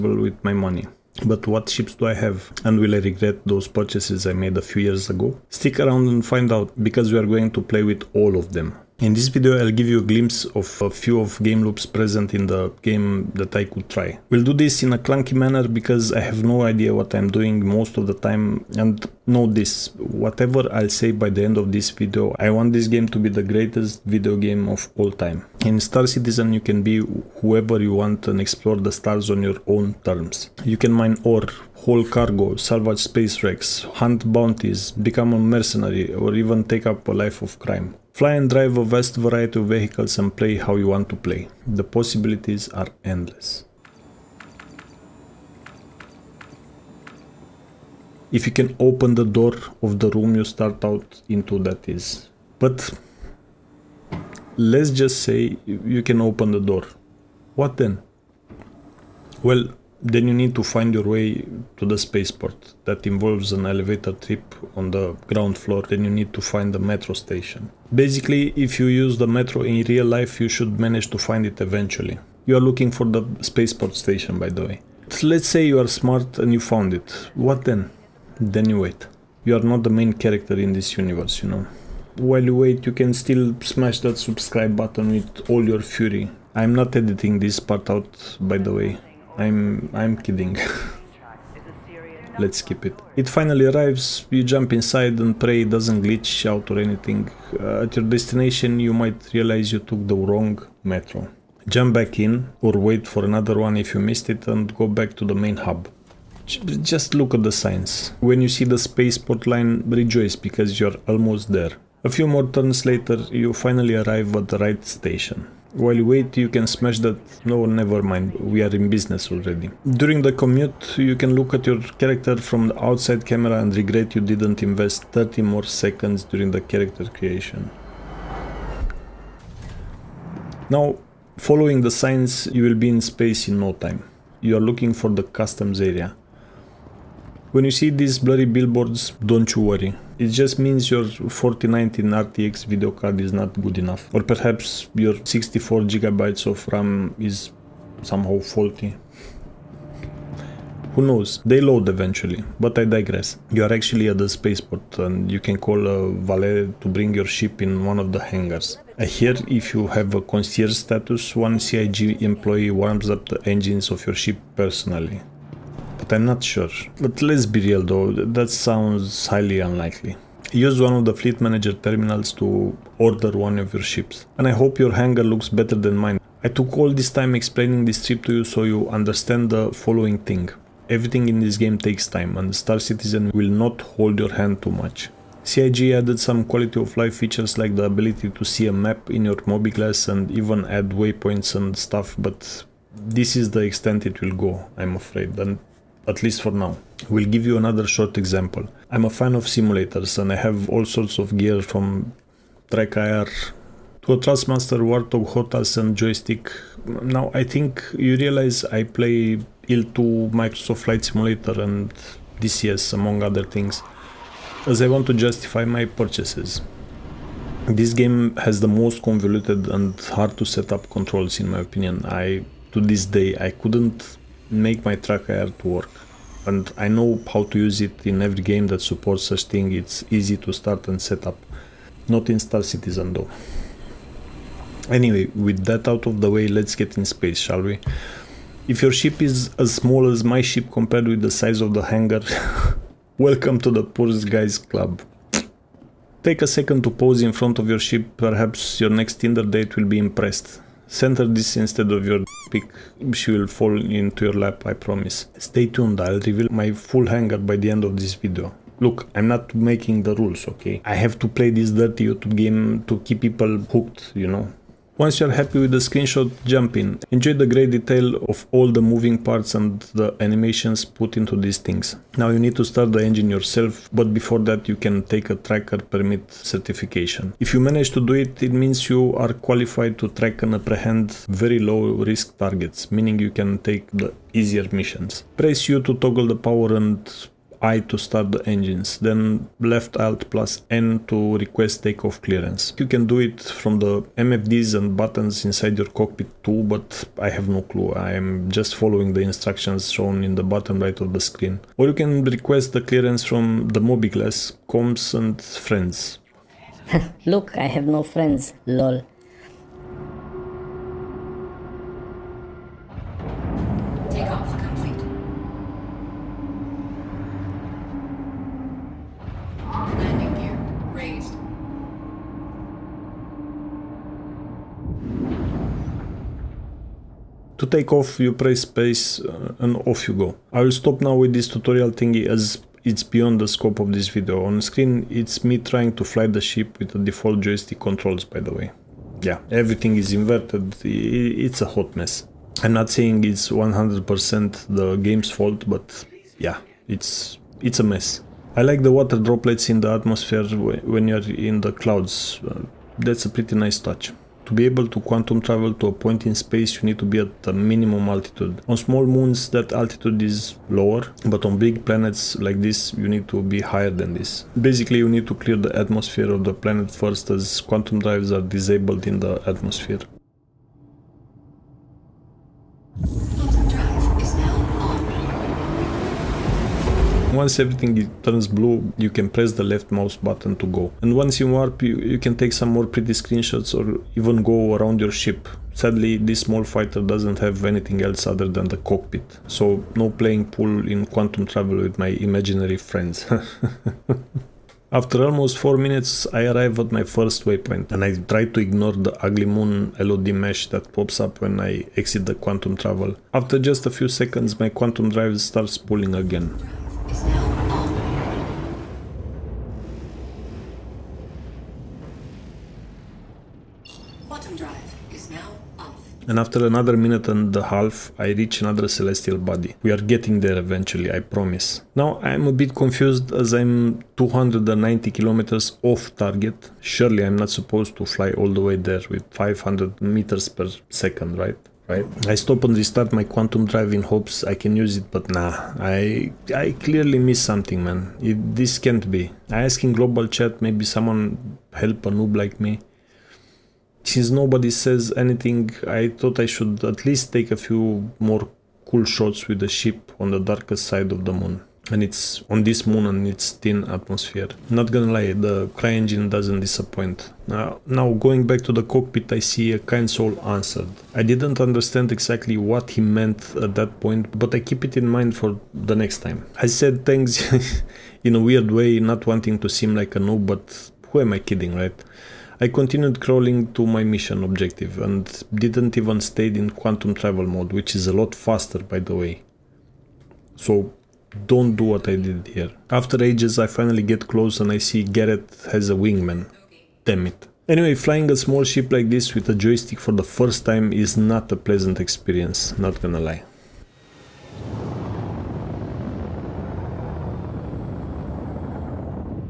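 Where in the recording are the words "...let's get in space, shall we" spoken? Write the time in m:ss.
3:56.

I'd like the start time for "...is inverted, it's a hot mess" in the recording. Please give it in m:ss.
5:39.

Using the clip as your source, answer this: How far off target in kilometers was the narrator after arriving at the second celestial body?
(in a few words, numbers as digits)
290 kilometers.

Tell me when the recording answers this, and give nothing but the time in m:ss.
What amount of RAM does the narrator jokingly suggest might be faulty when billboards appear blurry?
2:25.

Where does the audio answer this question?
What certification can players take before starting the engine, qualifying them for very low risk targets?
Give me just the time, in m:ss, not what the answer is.
4:35.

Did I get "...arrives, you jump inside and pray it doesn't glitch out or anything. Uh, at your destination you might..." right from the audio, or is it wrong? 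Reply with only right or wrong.
right.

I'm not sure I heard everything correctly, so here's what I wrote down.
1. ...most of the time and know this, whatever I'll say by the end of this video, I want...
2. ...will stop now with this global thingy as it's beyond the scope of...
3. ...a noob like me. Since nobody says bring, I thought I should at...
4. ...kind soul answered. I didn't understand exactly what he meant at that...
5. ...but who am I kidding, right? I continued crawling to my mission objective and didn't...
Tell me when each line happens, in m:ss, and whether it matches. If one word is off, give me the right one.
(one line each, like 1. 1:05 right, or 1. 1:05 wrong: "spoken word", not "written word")
1. 0:17 right
2. 5:30 wrong: "tutorial", not "global"
3. 7:22 wrong: "anything", not "bring"
4. 7:39 right
5. 7:50 right.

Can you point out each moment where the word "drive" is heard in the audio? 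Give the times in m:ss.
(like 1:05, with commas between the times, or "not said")
0:38, 6:07, 6:45, 7:13.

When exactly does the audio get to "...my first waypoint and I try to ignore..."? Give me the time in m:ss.
6:36.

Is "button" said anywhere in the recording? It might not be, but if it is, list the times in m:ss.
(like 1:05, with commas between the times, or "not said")
1:24, 4:54, 6:20.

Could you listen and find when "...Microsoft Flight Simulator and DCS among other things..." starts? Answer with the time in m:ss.
3:30.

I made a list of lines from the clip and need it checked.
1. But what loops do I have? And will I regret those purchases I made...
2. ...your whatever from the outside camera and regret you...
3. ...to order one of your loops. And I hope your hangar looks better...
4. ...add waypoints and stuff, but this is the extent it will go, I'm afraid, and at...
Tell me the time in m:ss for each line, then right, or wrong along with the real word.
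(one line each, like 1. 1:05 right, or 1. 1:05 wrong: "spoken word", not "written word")
1. 0:01 wrong: "ships", not "loops"
2. 2:01 wrong: "character", not "whatever"
3. 2:52 wrong: "ships", not "loops"
4. 3:10 right.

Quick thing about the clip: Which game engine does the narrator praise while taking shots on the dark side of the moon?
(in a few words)
CryEngine.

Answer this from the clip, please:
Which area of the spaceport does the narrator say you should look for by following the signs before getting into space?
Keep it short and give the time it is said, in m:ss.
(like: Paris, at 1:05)
customs area, at 2:15.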